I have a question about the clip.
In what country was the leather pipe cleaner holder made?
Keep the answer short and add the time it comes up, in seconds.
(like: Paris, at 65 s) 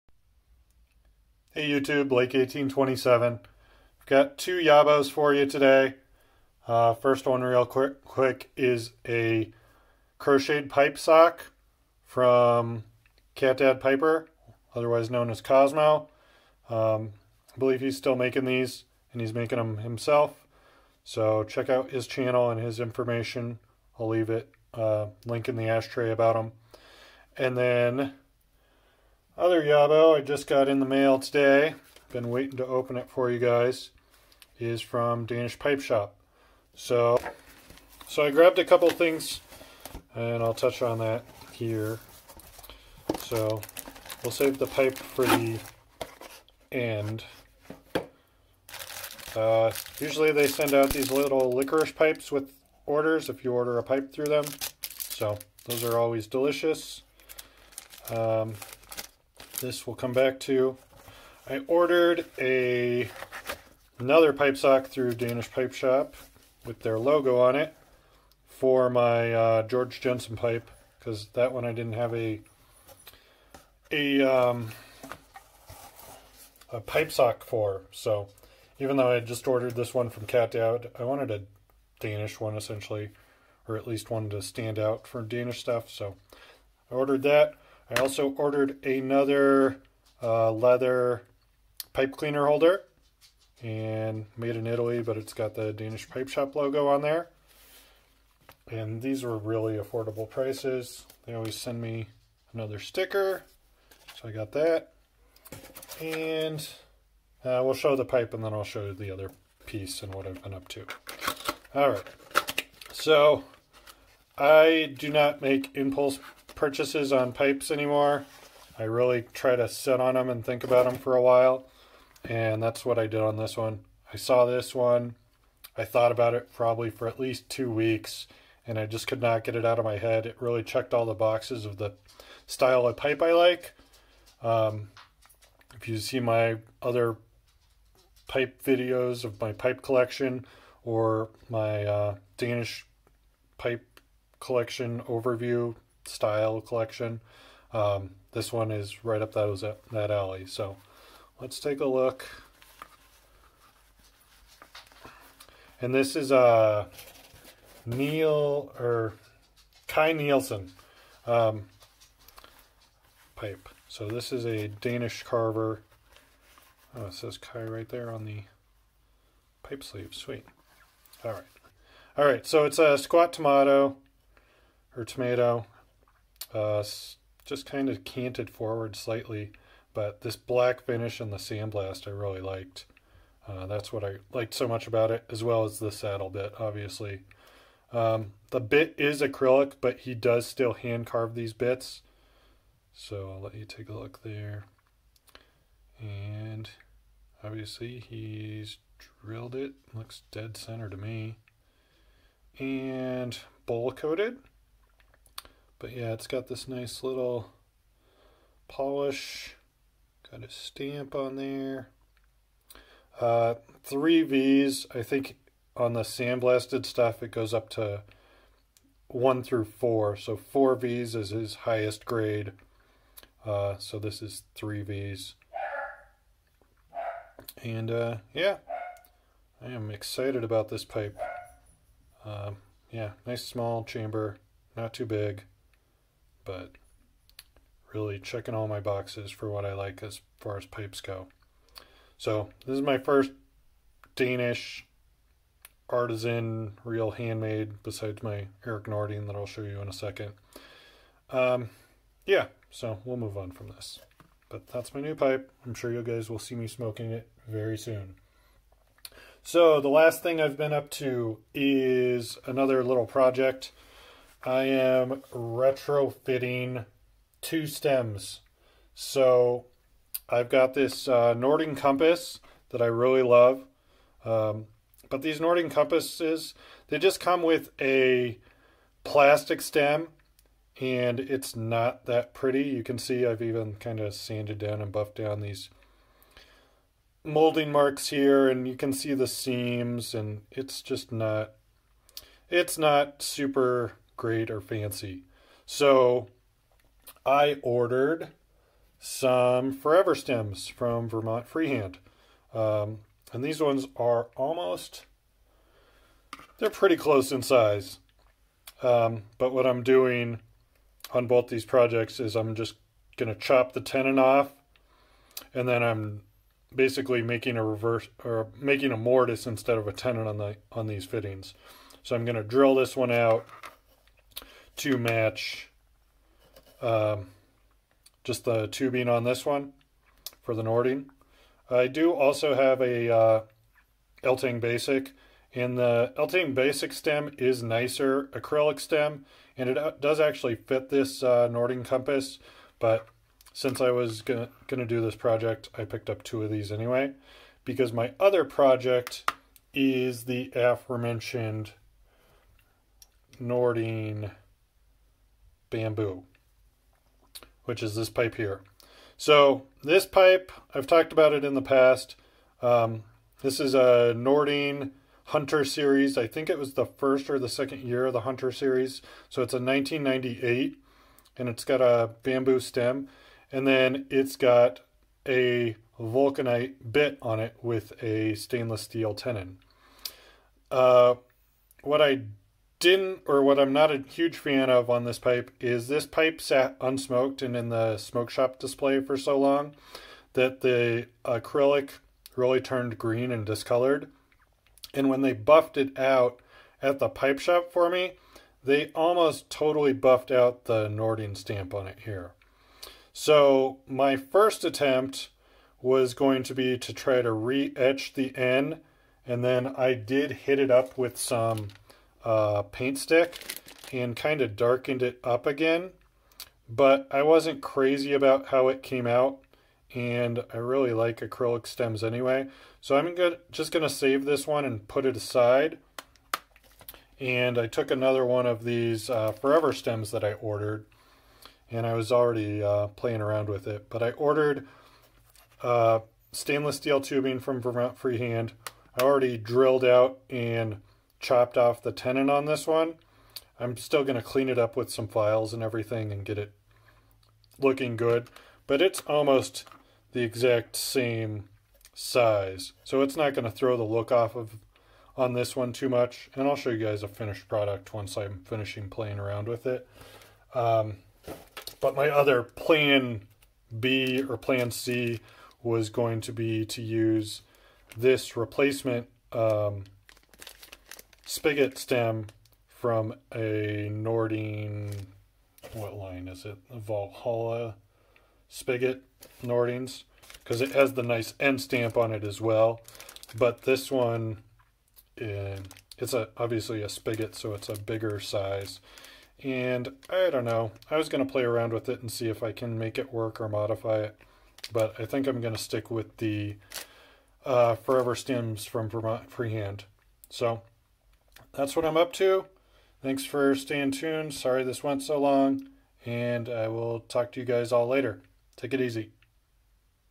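Italy, at 94 s.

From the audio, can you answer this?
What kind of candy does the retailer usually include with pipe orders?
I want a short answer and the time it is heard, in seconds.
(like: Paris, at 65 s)
licorice pipes, at 51 s.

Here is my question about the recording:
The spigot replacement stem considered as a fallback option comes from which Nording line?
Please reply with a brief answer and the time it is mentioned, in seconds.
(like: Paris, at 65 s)
Valhalla, at 476 s.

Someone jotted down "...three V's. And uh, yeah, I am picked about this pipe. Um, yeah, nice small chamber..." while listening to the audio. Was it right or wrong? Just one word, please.
wrong.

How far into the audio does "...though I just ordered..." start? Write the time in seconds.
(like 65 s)
78 s.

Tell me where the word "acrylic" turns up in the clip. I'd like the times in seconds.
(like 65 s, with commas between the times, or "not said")
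189 s, 338 s, 391 s, 421 s.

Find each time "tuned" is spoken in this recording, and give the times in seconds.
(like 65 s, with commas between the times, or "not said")
503 s.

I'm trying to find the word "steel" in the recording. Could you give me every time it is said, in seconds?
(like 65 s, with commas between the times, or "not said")
378 s, 436 s.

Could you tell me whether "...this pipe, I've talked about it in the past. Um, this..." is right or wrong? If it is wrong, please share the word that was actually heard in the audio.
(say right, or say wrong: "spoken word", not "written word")
right.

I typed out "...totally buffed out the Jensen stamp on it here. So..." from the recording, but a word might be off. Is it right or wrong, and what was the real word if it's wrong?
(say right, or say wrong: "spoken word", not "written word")
wrong: "Nording", not "Jensen".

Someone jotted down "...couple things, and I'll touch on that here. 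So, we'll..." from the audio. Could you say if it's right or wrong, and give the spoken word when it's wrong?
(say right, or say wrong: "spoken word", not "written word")
right.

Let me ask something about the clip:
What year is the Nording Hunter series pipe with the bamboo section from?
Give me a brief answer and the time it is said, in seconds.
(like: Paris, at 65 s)
1998, at 369 s.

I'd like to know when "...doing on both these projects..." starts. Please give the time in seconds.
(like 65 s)
309 s.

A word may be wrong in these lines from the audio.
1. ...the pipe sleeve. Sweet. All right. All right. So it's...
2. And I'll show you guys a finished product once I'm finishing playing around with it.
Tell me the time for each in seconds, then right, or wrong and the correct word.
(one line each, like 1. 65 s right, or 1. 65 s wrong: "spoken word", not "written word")
1. 168 s right
2. 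456 s right.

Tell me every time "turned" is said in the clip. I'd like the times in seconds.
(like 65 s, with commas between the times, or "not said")
392 s.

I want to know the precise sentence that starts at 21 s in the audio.
So check out his channel and his information.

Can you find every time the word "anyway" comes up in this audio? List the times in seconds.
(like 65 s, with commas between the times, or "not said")
346 s, 422 s.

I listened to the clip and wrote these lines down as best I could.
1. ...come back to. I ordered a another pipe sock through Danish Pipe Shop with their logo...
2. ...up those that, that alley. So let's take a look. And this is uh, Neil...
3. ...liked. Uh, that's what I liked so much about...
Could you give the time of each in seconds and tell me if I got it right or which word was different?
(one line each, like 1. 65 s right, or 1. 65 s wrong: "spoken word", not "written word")
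1. 59 s right
2. 149 s right
3. 182 s right.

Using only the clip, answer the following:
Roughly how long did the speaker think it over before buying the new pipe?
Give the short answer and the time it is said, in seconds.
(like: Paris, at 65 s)
two weeks, at 127 s.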